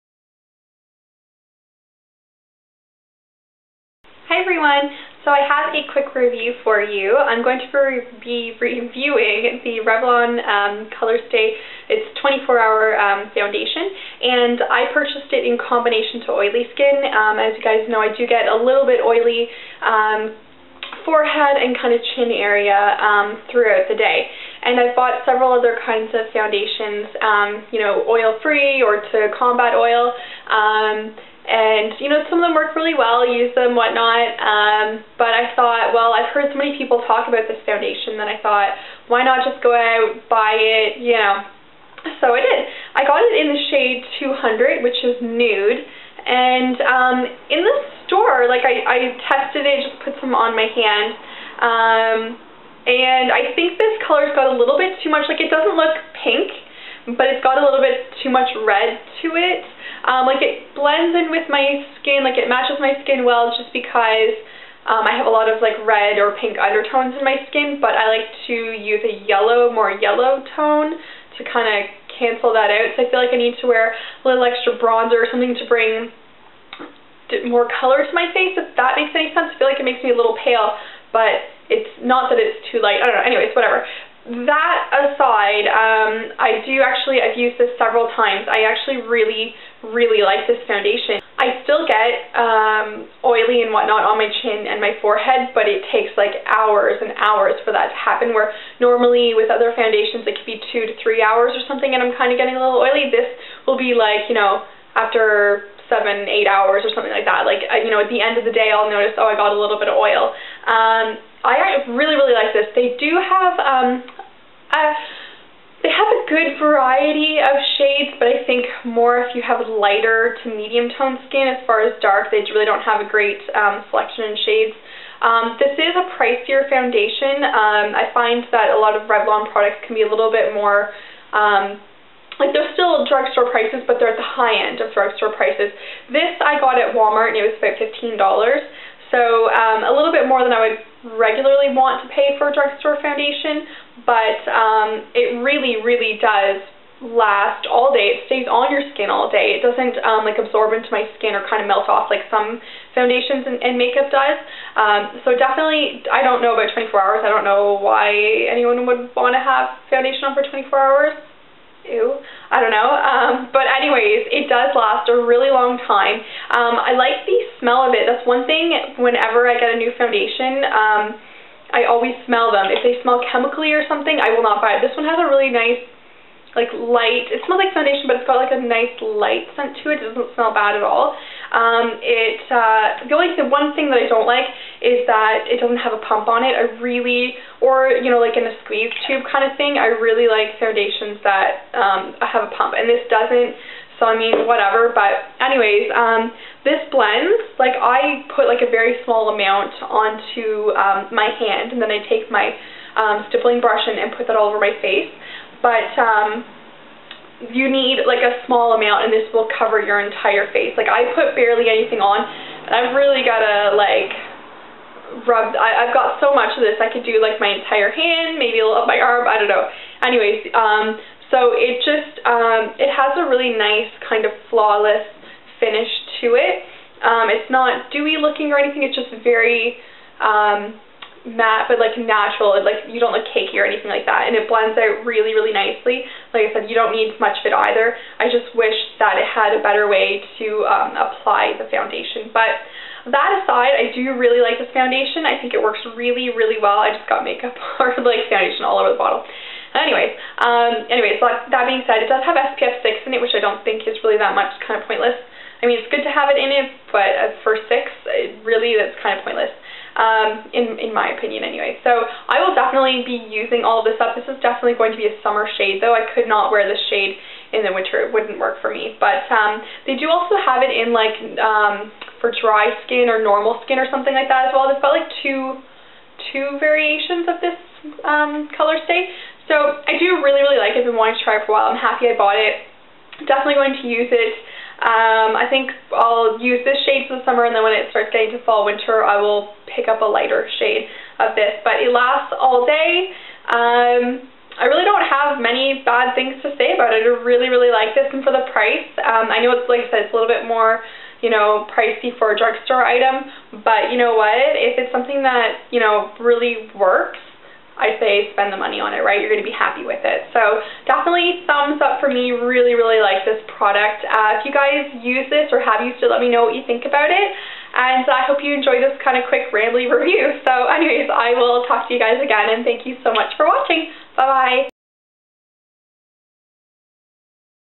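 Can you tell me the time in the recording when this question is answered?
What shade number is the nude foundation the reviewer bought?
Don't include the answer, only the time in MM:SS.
00:44.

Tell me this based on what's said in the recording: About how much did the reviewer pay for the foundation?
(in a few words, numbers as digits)
$15.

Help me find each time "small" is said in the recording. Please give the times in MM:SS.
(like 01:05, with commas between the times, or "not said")
03:19, 03:28.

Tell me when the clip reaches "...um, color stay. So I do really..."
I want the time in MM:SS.
04:38.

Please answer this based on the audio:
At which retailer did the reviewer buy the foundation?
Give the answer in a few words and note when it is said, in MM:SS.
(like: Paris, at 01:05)
Walmart, at 02:16.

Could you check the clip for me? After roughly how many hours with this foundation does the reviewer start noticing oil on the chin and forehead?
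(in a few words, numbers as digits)
7 to 8 hours.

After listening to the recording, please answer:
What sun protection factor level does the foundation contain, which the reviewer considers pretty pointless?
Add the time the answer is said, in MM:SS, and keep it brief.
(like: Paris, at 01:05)
SPF 6, at 04:12.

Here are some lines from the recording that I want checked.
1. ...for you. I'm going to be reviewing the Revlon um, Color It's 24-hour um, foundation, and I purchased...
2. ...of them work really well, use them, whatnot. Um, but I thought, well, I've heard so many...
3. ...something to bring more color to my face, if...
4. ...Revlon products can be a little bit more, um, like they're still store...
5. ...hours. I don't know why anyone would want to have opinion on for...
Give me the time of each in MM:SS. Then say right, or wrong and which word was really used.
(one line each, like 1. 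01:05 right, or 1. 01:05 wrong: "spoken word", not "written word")
1. 00:06 right
2. 00:32 right
3. 01:15 right
4. 02:09 wrong: "drugstore", not "store"
5. 02:36 wrong: "foundation", not "opinion".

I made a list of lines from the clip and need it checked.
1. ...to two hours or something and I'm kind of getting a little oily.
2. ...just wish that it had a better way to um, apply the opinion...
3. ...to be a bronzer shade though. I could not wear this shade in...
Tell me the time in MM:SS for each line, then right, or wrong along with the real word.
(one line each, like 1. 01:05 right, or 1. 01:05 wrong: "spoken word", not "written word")
1. 01:40 wrong: "three", not "two"
2. 03:58 wrong: "foundation", not "opinion"
3. 04:24 wrong: "summer", not "bronzer".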